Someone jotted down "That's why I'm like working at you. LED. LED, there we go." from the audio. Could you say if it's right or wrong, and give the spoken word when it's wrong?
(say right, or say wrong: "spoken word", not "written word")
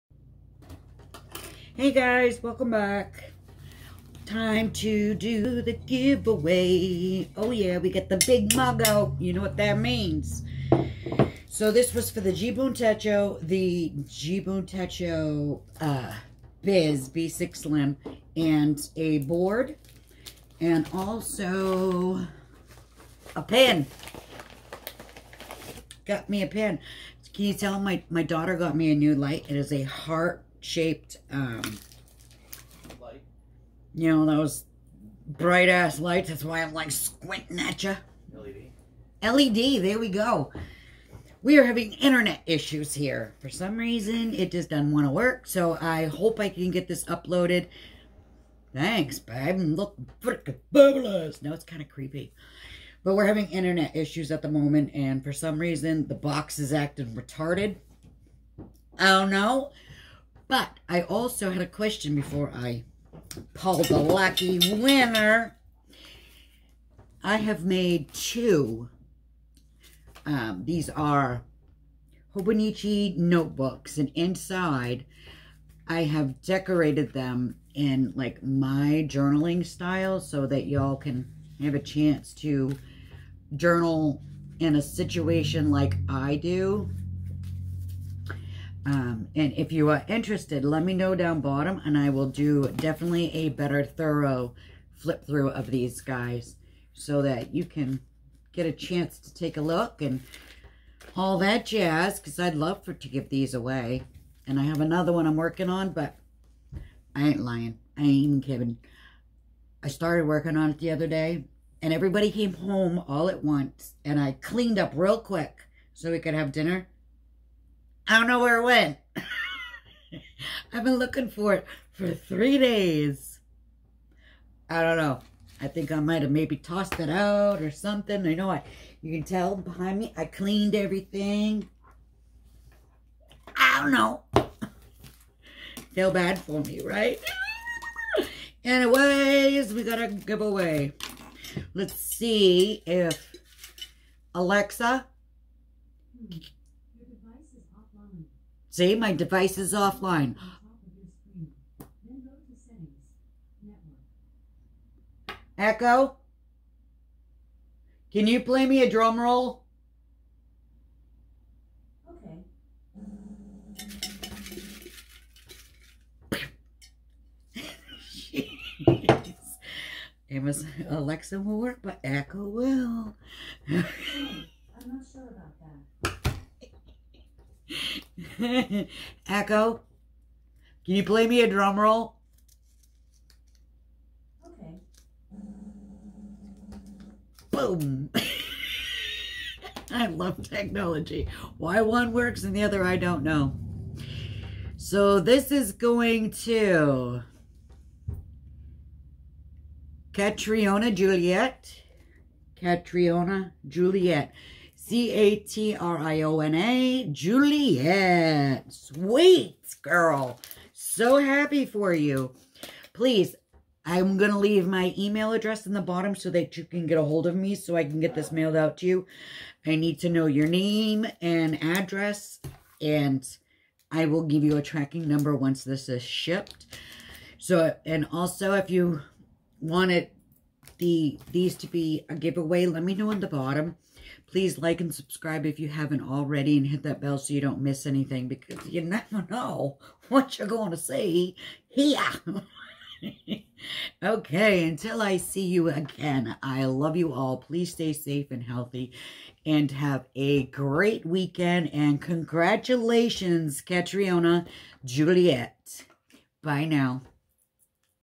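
wrong: "squinting", not "working".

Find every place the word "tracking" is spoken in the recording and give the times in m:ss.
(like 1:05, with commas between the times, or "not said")
3:44.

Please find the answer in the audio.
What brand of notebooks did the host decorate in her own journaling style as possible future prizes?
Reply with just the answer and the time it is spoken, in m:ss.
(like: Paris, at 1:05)
Hobonichi, at 1:12.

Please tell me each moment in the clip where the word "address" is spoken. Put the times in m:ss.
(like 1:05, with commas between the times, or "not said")
3:35, 3:41.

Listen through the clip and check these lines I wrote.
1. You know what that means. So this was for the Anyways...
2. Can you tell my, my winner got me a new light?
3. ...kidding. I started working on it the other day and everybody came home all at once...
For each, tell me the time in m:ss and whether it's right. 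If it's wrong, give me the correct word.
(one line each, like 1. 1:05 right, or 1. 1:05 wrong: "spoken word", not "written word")
1. 0:09 wrong: "Jibun", not "Anyways"
2. 0:27 wrong: "daughter", not "winner"
3. 1:48 right.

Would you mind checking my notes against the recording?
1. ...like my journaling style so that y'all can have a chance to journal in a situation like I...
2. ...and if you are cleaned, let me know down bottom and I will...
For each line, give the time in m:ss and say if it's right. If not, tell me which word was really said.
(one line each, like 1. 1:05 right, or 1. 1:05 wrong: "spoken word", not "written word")
1. 1:18 right
2. 1:29 wrong: "interested", not "cleaned".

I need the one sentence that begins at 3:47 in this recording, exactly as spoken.
So, and also if you want it the these to be a giveaway, let me know in the bottom.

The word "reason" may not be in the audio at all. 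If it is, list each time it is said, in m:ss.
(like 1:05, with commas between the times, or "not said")
0:43, 0:55.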